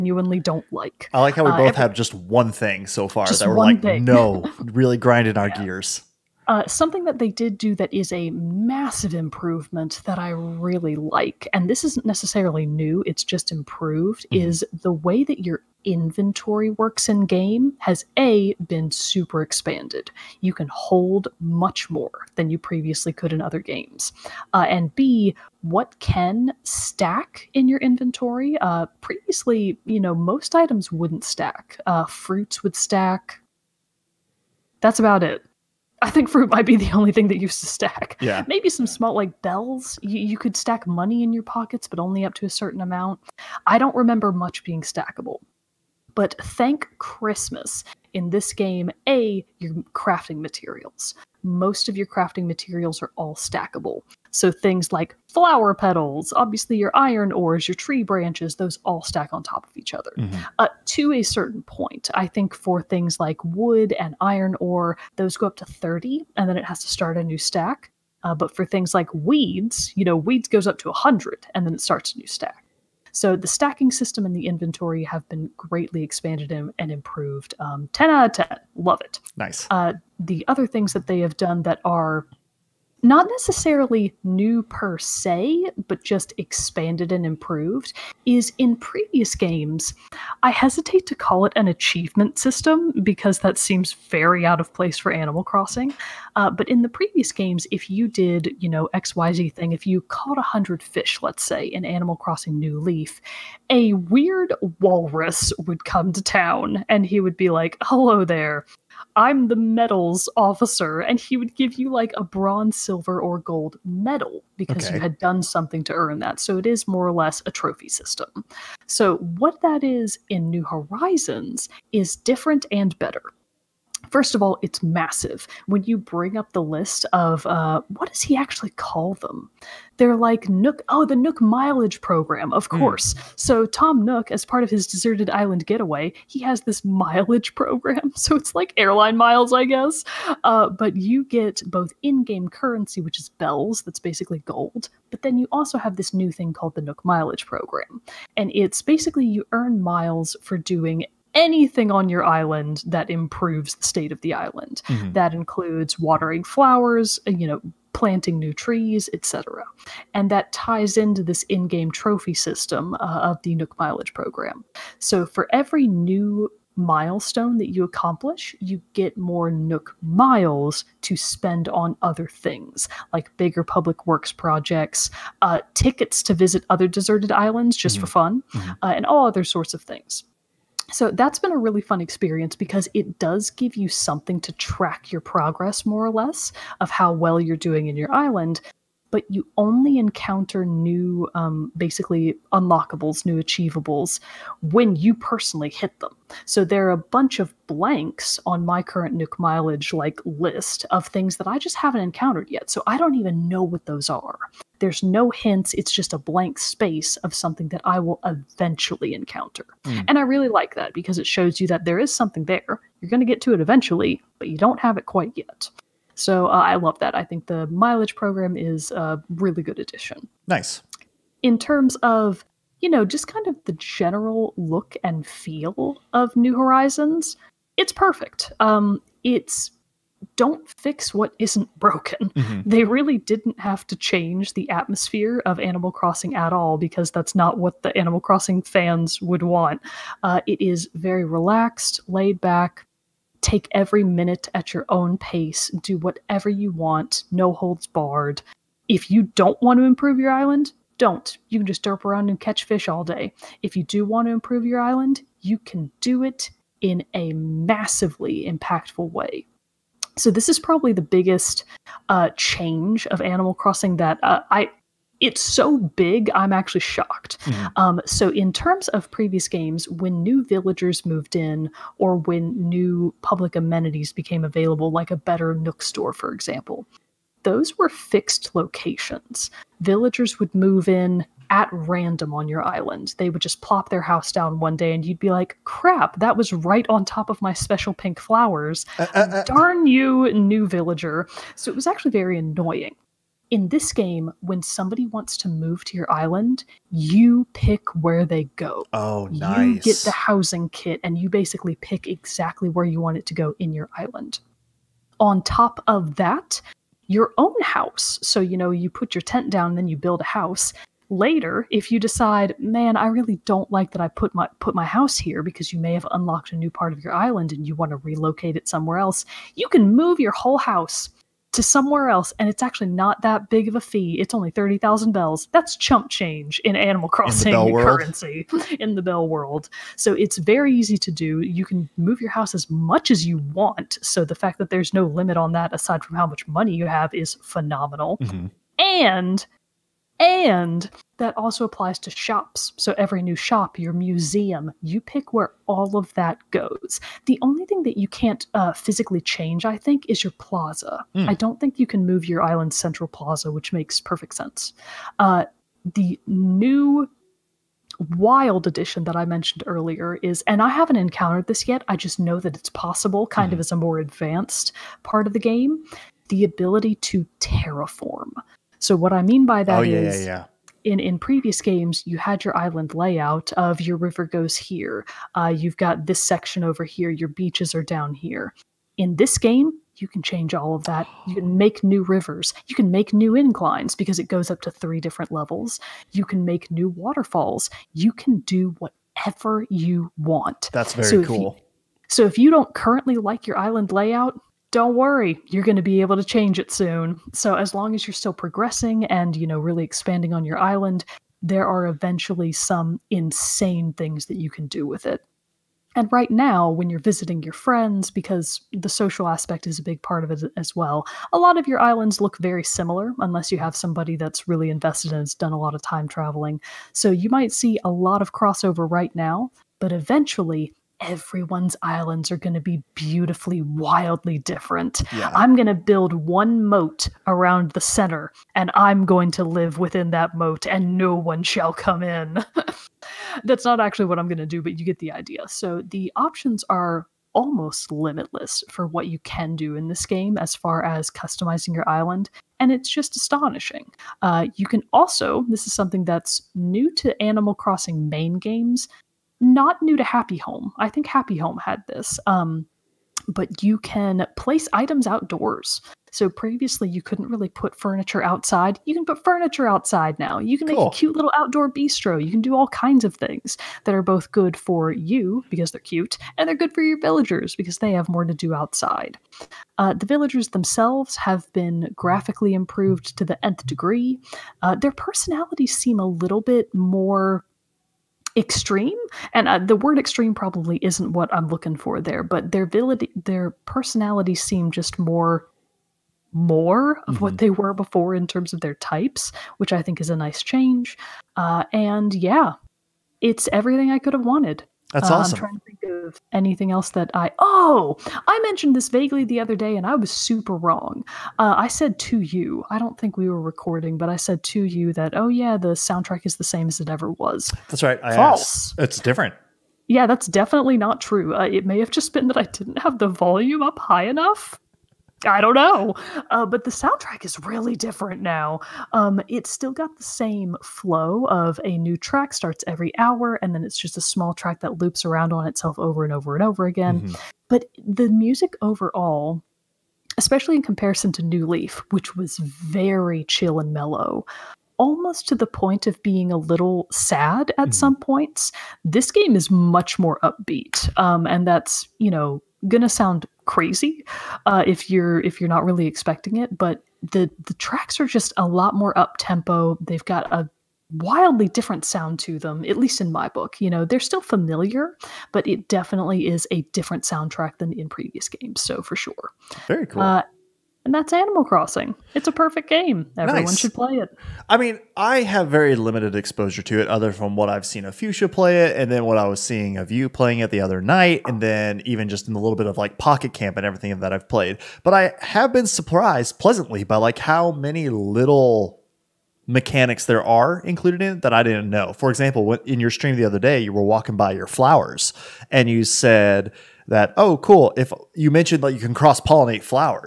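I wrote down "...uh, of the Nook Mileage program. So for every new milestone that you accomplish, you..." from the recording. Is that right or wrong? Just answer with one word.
right.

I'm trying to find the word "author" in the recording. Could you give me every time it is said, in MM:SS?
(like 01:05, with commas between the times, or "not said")
not said.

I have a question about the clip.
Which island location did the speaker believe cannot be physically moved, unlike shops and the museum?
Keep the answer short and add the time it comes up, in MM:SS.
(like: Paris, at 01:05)
Central plaza, at 05:52.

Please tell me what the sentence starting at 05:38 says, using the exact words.
and and that also applies to shops.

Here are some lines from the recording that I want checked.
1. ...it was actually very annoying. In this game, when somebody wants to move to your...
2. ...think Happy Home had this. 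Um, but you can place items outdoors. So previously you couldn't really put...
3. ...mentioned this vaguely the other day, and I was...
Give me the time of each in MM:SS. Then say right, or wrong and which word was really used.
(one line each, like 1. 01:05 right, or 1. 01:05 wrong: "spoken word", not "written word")
1. 04:51 right
2. 07:30 right
3. 08:18 right.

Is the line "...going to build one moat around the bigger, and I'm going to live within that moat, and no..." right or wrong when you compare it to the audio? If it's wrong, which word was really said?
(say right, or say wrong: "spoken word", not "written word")
wrong: "center", not "bigger".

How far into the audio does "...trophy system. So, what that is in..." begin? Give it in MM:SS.
01:57.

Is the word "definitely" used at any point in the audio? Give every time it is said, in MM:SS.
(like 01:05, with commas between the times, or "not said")
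08:30, 09:15.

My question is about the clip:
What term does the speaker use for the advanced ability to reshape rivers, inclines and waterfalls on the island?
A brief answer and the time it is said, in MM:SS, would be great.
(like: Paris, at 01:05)
Terraform, at 06:07.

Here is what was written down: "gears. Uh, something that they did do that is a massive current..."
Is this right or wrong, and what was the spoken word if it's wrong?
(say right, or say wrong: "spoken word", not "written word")
wrong: "improvement", not "current".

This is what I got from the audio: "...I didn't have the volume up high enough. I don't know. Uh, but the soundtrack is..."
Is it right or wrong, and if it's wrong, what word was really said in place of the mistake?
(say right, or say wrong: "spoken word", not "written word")
right.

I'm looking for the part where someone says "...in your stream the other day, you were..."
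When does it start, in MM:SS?
09:42.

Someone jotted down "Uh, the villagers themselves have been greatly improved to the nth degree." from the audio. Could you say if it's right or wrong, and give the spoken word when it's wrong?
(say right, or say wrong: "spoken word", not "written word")
wrong: "graphically", not "greatly".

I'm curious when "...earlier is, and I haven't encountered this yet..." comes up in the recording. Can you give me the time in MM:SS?
05:59.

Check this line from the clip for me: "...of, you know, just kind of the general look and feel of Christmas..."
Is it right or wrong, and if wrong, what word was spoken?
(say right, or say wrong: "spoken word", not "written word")
wrong: "New", not "Christmas".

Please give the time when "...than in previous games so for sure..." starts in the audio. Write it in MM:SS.
09:17.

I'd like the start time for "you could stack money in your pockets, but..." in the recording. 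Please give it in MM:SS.
00:40.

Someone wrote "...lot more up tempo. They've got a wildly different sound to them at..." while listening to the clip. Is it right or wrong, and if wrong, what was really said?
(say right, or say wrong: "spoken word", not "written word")
right.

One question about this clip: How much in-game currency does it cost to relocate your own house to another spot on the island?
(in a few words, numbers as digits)
30,000 bells.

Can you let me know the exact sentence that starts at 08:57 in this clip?
some points, this game is much more upbeat.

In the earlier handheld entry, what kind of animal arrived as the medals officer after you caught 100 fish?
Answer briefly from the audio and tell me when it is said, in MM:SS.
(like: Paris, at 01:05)
Walrus, at 01:44.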